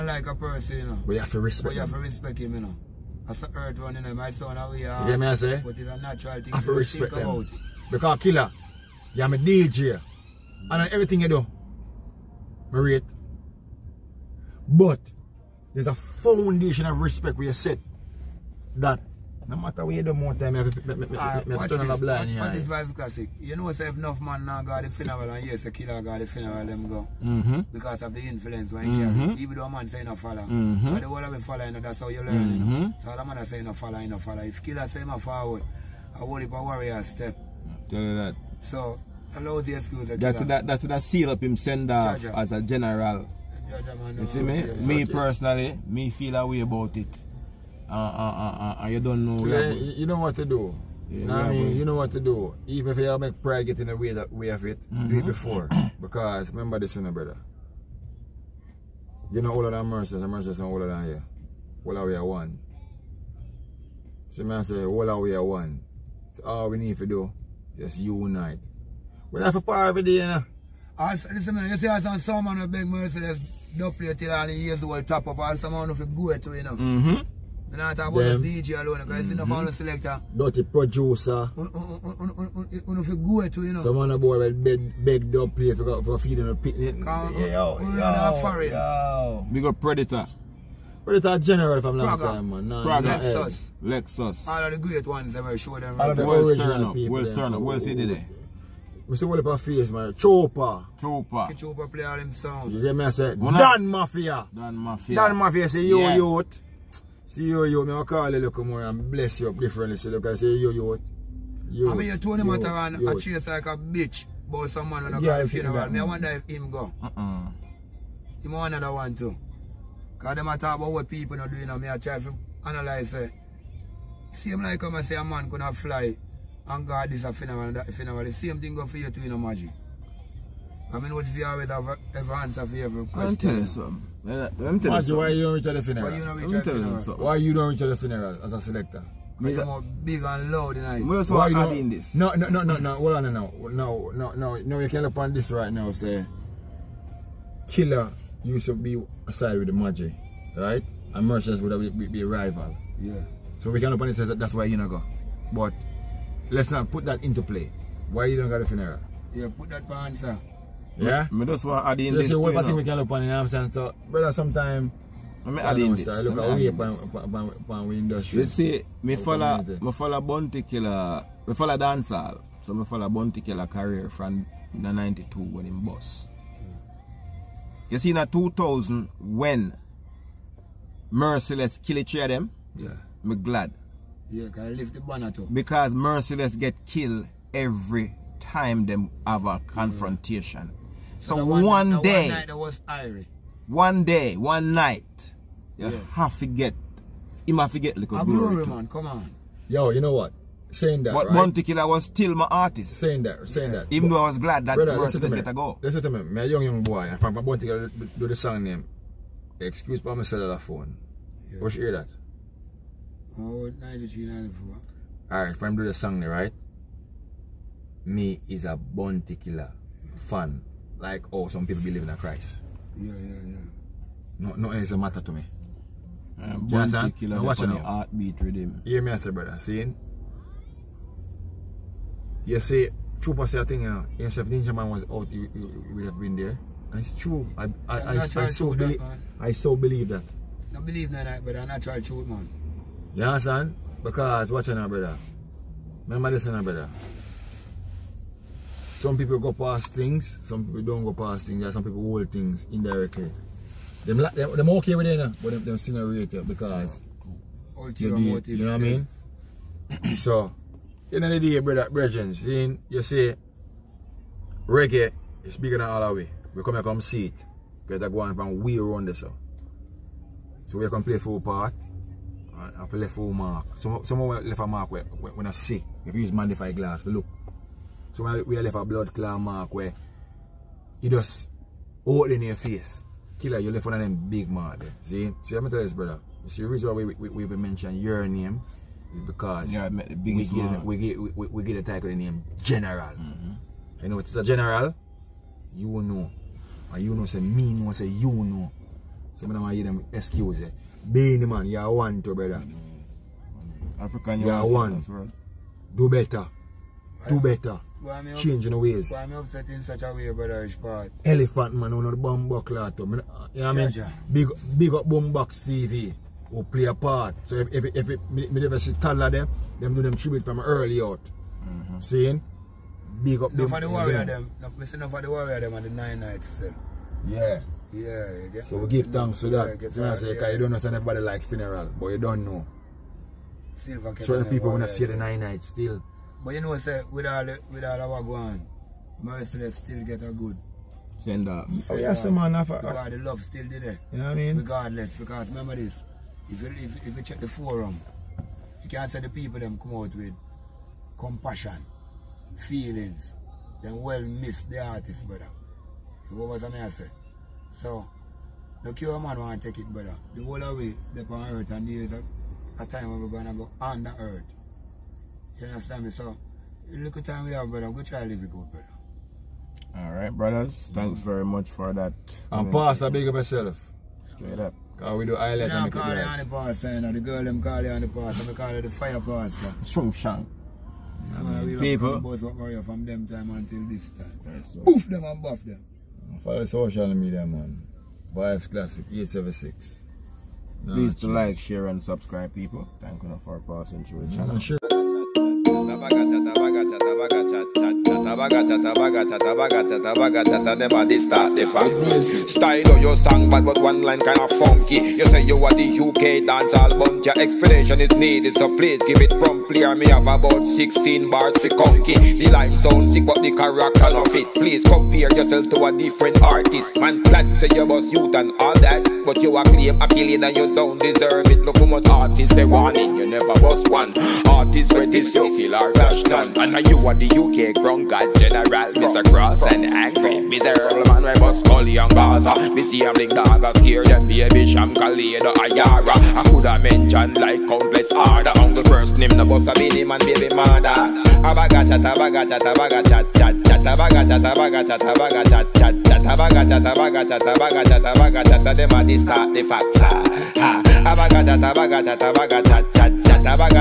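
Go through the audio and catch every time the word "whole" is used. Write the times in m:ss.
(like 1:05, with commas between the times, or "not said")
0:31, 6:00.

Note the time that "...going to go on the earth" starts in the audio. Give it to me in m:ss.
6:03.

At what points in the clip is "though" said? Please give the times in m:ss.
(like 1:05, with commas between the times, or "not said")
0:29, 3:24.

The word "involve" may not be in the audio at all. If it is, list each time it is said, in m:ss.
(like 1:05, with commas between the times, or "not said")
not said.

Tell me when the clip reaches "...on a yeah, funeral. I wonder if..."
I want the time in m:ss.
1:55.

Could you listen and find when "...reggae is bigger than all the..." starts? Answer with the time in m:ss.
4:24.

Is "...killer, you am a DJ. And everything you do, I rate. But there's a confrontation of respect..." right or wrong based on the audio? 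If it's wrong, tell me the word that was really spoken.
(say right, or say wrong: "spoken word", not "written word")
wrong: "foundation", not "confrontation".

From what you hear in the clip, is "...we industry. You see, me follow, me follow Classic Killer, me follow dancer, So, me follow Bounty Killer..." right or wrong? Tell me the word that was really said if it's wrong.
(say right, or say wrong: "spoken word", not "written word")
wrong: "Bounty", not "Classic".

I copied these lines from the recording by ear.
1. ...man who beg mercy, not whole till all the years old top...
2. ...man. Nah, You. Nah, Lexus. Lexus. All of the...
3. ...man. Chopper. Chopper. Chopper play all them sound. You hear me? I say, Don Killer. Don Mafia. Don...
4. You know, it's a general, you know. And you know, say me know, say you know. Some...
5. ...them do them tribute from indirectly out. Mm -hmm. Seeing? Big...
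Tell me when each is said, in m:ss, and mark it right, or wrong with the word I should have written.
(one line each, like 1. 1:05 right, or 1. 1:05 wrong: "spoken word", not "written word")
1. 1:12 wrong: "double", not "whole"
2. 1:32 wrong: "Praga", not "You"
3. 1:39 wrong: "Mafia", not "Killer"
4. 4:54 right
5. 5:19 wrong: "early", not "indirectly".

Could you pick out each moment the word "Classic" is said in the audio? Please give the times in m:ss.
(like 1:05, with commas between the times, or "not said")
0:22, 6:28.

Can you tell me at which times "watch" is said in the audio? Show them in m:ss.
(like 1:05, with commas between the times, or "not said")
3:47, 4:04.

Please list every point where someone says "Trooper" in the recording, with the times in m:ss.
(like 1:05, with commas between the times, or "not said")
3:53.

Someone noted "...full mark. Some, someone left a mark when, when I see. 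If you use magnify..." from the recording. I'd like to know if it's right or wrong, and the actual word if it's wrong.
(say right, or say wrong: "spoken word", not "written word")
right.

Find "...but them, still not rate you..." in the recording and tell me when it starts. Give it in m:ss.
4:15.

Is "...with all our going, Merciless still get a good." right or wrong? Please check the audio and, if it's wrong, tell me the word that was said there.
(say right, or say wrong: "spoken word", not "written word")
right.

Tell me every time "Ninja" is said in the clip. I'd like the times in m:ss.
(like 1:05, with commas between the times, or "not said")
3:54.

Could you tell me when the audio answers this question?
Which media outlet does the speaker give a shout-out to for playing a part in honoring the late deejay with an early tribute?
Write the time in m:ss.
5:15.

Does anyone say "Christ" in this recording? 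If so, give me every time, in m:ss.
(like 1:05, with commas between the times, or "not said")
3:42.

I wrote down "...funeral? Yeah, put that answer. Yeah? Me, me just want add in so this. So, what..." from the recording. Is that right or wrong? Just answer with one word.
right.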